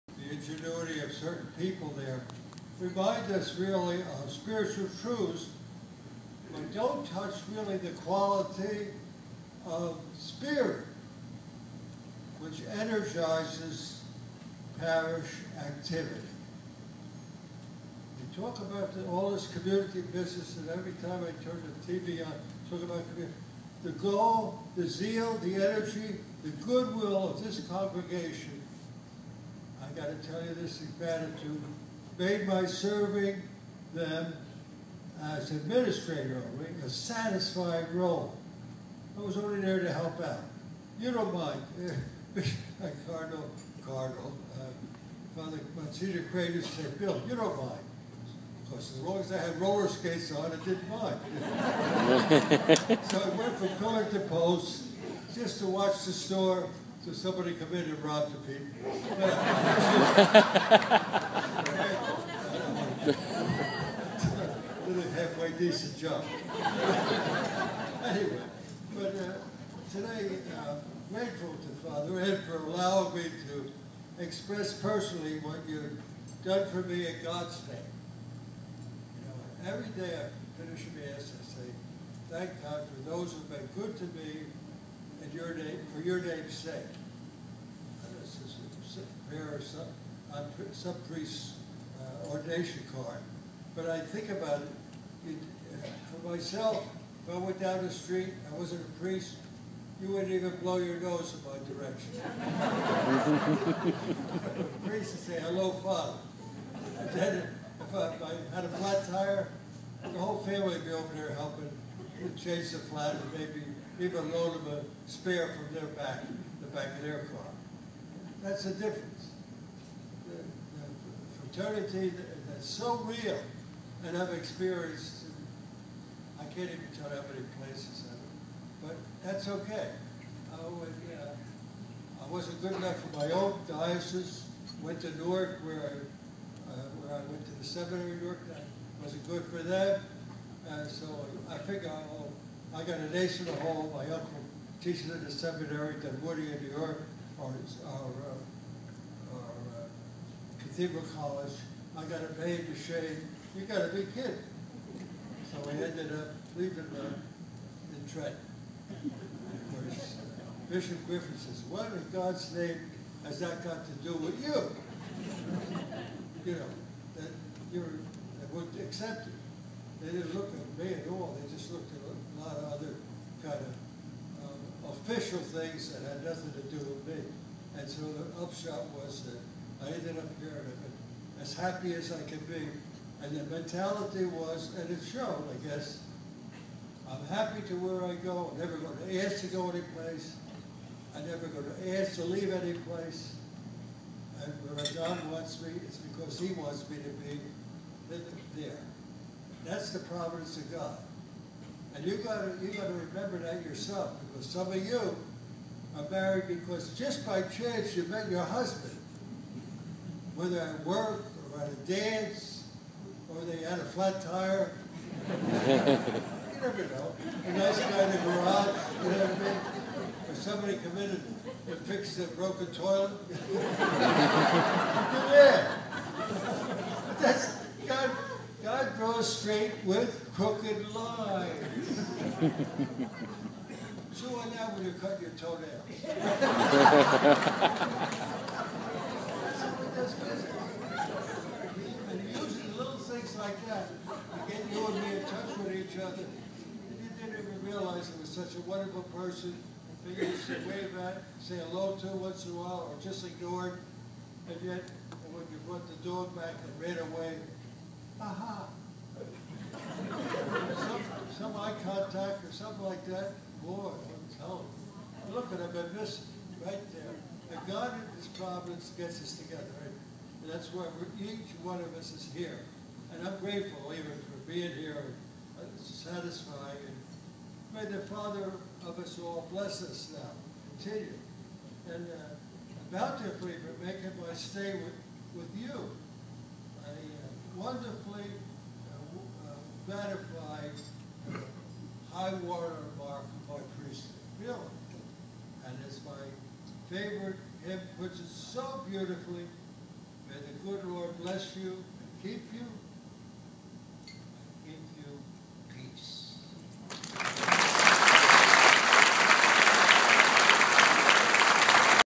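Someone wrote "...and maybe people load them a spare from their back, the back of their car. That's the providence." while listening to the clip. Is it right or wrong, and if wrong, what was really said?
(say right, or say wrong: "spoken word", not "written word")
wrong: "difference", not "providence".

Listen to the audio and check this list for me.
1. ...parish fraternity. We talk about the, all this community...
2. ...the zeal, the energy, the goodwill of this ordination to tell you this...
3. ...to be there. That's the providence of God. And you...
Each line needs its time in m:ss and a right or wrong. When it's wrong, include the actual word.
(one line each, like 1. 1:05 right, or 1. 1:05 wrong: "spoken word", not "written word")
1. 0:14 wrong: "activity", not "fraternity"
2. 0:24 wrong: "congregation", not "ordination"
3. 3:16 right.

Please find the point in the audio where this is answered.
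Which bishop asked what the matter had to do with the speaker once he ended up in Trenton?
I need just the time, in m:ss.
2:40.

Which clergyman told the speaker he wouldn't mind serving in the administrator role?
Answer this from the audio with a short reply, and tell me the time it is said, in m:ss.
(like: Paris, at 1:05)
Monsignor Crater, at 0:45.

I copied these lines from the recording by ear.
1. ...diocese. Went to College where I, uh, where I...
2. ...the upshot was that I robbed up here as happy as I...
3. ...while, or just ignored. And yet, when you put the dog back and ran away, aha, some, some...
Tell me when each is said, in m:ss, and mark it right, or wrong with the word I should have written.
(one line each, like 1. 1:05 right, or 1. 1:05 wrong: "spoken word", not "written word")
1. 2:13 wrong: "Newark", not "College"
2. 2:58 wrong: "ended", not "robbed"
3. 4:12 right.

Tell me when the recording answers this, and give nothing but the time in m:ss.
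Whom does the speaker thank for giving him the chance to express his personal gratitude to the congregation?
1:11.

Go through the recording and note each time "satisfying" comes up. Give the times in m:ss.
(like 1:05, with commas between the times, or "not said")
0:36, 4:35.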